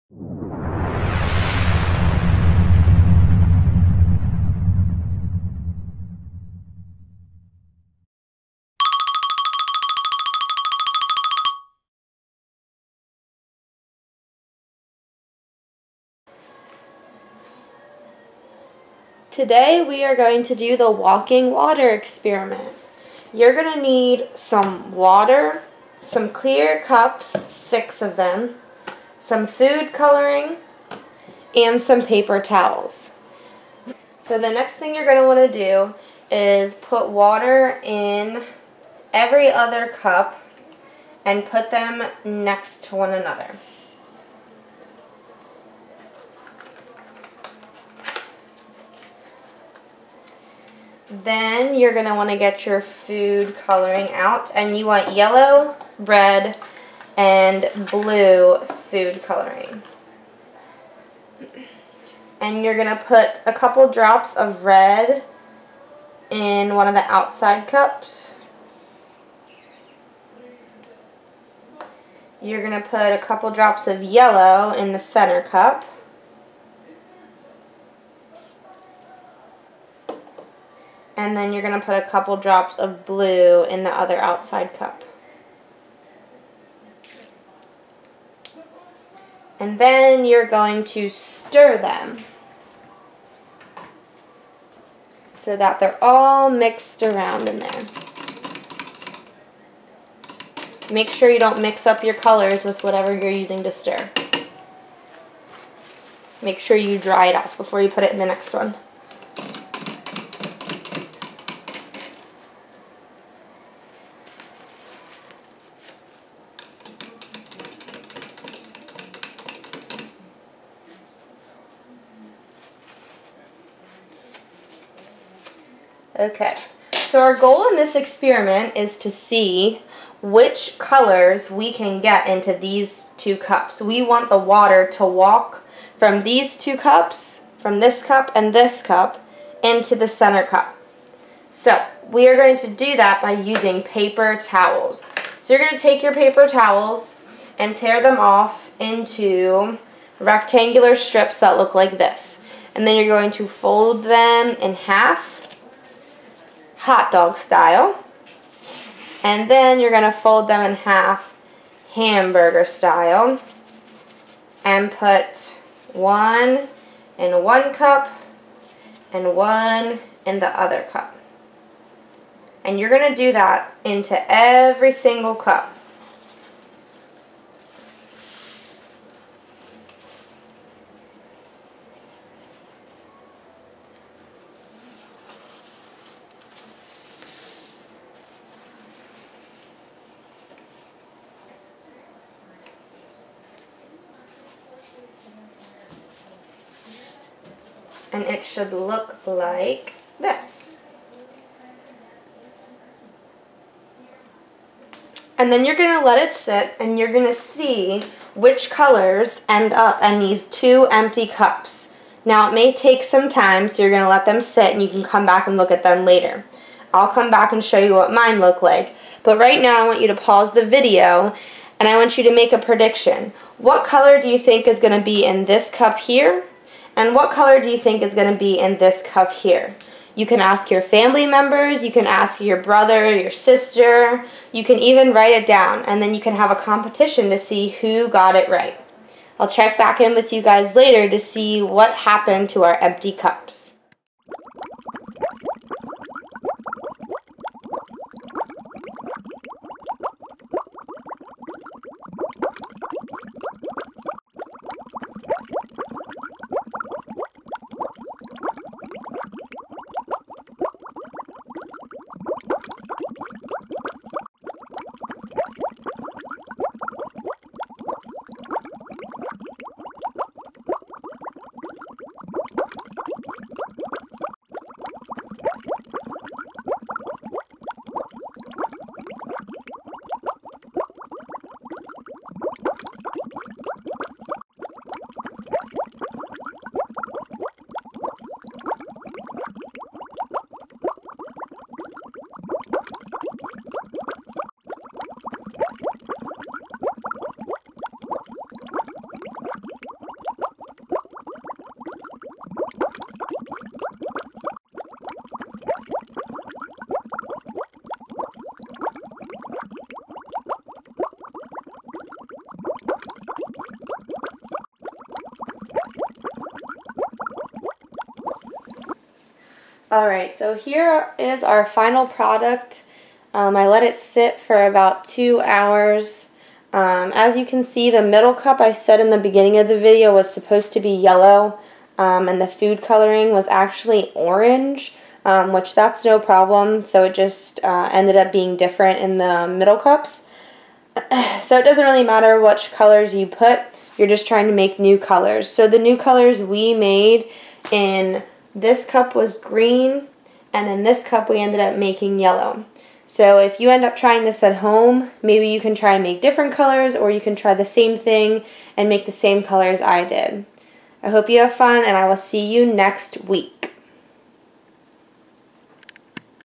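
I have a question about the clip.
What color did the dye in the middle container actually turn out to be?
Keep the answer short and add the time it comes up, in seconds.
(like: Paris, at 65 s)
orange, at 334 s.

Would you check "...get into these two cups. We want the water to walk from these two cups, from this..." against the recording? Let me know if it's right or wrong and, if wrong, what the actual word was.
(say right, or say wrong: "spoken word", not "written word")
right.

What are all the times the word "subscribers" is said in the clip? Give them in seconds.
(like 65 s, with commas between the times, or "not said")
not said.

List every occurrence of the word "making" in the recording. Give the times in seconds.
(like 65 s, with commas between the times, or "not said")
351 s.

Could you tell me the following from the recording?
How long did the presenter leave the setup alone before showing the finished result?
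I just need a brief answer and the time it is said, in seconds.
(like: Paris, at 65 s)
about two hours, at 324 s.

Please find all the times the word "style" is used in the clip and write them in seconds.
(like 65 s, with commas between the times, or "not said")
157 s, 162 s.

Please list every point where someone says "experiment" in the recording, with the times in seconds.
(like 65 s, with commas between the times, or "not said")
21 s, 127 s.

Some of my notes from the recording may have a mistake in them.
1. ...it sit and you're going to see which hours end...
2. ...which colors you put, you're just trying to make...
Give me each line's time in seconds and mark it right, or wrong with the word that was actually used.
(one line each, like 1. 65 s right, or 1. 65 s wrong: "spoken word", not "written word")
1. 206 s wrong: "colors", not "hours"
2. 342 s right.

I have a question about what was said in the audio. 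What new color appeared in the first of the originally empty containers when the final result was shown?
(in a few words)
green.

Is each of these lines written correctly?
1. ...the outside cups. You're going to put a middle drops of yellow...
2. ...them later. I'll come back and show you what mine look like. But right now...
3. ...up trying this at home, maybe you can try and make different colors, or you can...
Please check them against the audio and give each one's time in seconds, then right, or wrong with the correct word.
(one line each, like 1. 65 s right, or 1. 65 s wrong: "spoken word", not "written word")
1. 66 s wrong: "couple", not "middle"
2. 215 s right
3. 353 s right.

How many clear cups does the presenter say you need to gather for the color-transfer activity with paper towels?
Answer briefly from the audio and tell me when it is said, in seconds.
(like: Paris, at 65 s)
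6, at 27 s.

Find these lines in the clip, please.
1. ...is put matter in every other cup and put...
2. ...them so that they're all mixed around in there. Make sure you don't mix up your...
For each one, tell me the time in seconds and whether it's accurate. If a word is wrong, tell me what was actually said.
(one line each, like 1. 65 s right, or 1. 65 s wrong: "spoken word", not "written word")
1. 36 s wrong: "water", not "matter"
2. 91 s right.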